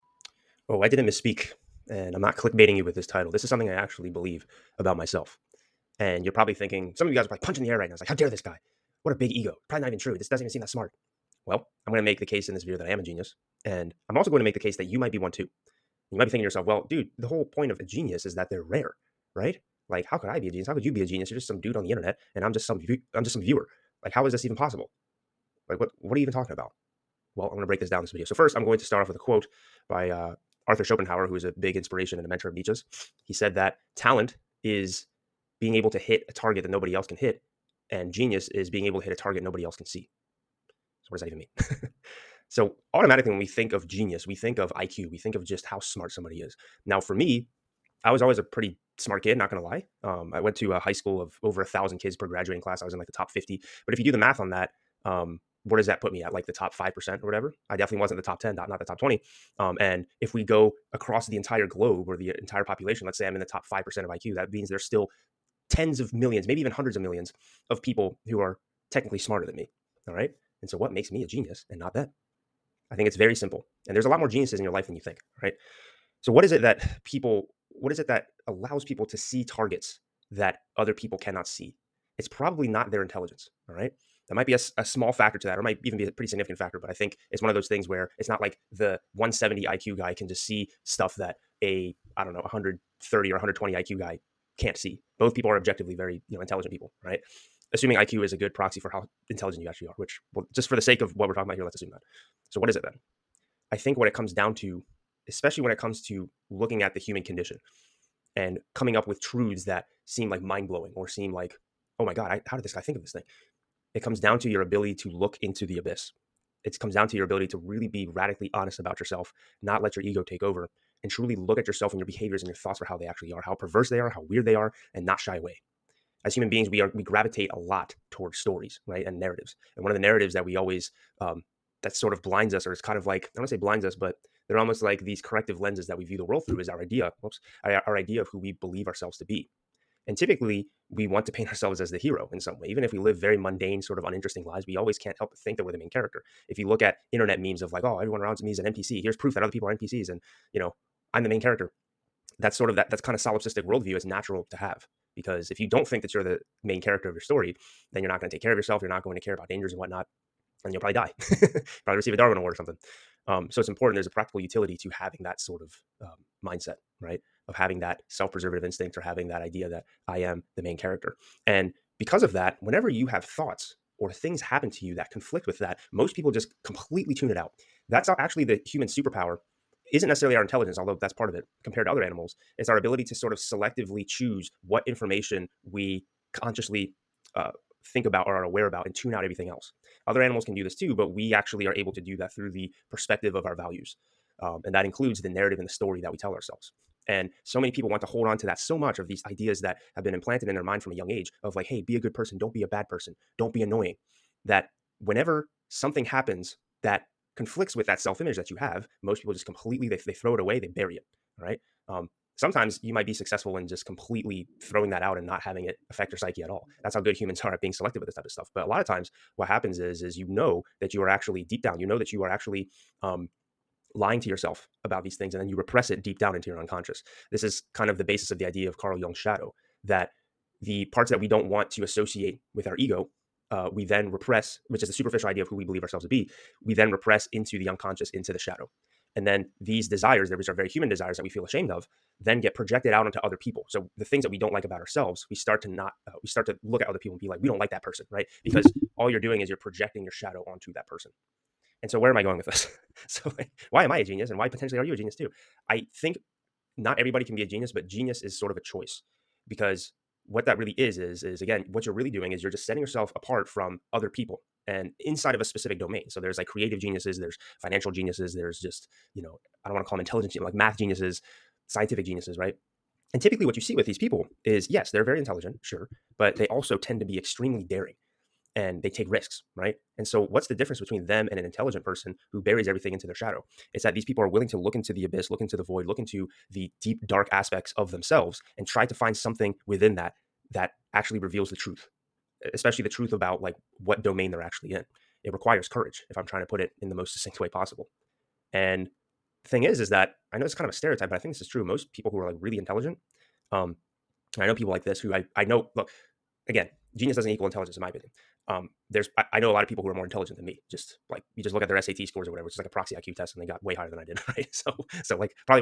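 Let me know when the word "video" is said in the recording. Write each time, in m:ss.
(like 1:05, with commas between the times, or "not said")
0:12, 0:28.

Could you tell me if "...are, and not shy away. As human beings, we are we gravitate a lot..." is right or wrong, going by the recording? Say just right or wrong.
right.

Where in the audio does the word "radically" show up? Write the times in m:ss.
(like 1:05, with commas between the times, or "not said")
1:58.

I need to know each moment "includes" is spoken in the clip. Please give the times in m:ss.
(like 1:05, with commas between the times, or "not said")
3:14.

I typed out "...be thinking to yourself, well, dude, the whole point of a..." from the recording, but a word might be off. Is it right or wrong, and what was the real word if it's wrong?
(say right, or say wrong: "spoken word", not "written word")
right.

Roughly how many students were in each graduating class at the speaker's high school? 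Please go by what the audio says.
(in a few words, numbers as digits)
over 1000.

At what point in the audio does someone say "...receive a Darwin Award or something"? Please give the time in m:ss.
2:41.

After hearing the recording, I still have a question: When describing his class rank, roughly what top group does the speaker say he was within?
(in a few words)
top 50.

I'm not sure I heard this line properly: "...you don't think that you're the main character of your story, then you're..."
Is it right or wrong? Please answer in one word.
right.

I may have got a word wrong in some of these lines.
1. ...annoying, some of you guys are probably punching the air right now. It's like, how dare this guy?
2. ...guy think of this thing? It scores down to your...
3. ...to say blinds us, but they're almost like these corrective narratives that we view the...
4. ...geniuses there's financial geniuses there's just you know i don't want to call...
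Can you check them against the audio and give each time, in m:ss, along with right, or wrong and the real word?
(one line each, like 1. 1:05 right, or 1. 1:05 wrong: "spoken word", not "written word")
1. 0:06 wrong: "thinking", not "annoying"
2. 1:52 wrong: "comes", not "scores"
3. 2:13 wrong: "lenses", not "narratives"
4. 4:26 right.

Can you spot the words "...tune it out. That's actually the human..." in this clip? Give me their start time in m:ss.
2:57.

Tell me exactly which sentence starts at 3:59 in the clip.
And then these desires, which are very human desires that we feel ashamed of, then get projected out onto other people.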